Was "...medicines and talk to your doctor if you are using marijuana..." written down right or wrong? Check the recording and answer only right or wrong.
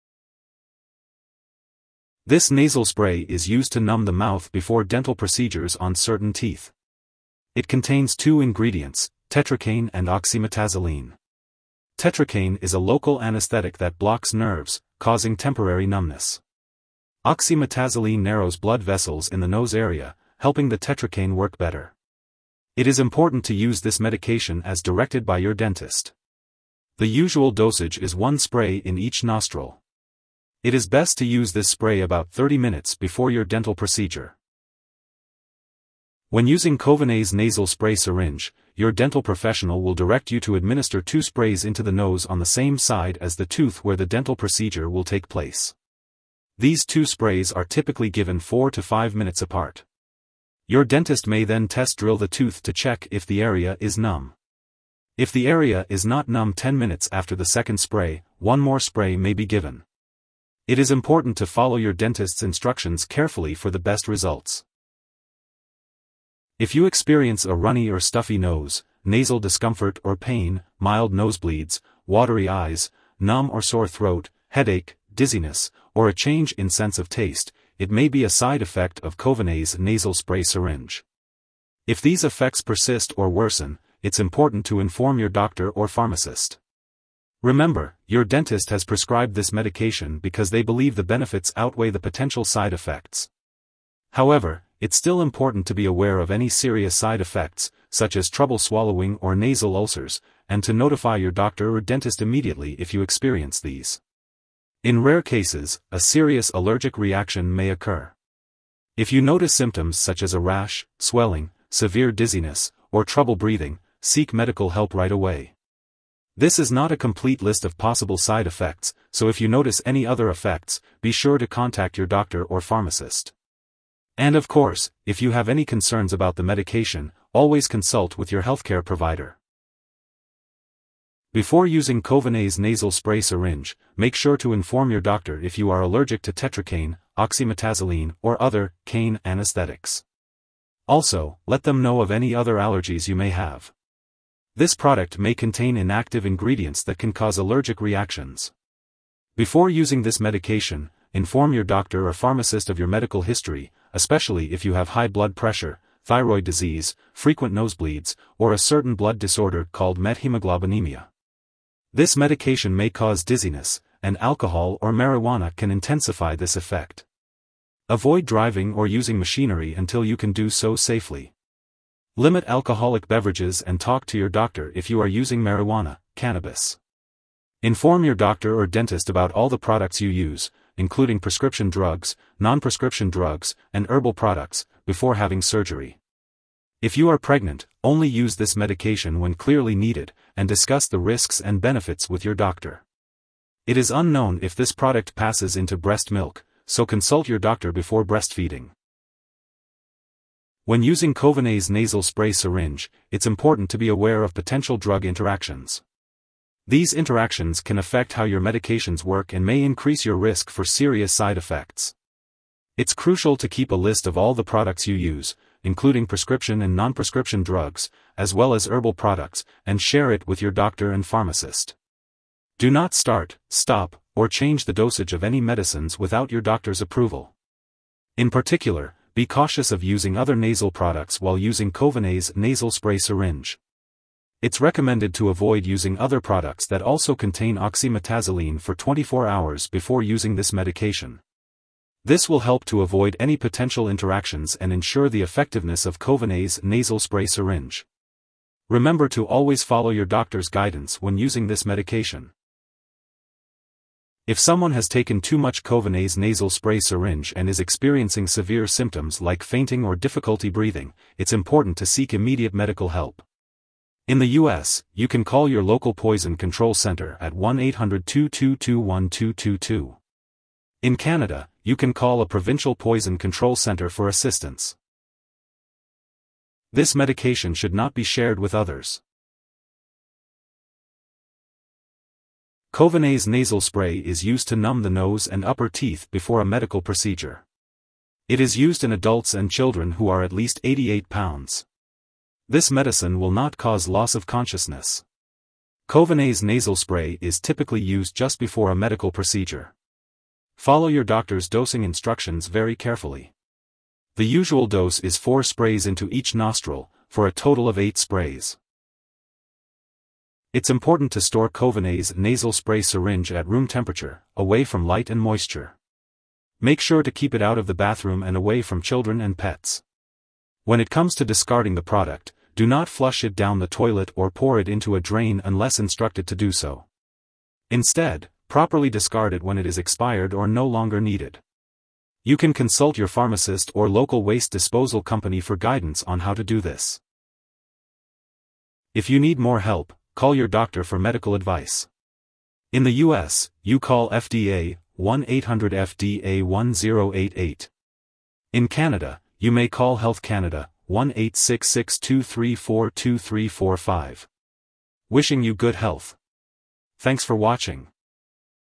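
wrong.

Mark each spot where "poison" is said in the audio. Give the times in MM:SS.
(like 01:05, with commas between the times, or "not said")
04:25, 04:32.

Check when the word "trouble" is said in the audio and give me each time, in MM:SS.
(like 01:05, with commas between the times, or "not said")
01:38, 01:53.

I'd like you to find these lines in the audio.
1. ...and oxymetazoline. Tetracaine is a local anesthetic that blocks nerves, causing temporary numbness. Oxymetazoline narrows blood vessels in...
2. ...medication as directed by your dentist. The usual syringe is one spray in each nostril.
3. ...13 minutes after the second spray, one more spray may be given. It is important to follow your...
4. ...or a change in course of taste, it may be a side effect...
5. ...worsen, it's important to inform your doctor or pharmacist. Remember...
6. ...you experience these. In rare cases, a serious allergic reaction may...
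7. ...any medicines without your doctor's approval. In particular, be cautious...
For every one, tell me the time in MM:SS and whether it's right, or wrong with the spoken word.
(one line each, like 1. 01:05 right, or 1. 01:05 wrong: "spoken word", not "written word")
1. 00:09 right
2. 00:23 wrong: "dosage", not "syringe"
3. 00:56 wrong: "10", not "13"
4. 01:15 wrong: "sense", not "course"
5. 01:23 right
6. 01:42 right
7. 03:45 right.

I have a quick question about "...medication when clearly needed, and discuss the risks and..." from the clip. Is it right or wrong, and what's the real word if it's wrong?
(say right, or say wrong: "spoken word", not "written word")
right.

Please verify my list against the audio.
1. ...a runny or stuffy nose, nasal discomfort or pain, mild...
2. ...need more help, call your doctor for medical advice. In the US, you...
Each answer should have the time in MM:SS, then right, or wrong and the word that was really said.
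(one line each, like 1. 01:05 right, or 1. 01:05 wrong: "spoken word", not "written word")
1. 01:07 right
2. 05:39 right.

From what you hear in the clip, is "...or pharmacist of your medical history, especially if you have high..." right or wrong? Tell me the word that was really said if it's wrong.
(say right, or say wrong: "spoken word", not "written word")
right.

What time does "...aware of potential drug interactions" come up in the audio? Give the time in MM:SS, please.
03:23.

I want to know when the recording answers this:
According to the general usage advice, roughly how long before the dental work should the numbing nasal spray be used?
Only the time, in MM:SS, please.
00:32.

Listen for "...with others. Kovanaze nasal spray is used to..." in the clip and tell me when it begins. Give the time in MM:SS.
04:38.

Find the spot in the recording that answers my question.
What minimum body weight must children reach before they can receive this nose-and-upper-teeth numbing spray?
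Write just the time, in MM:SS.
04:50.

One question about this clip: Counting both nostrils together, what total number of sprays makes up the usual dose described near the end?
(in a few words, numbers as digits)
8.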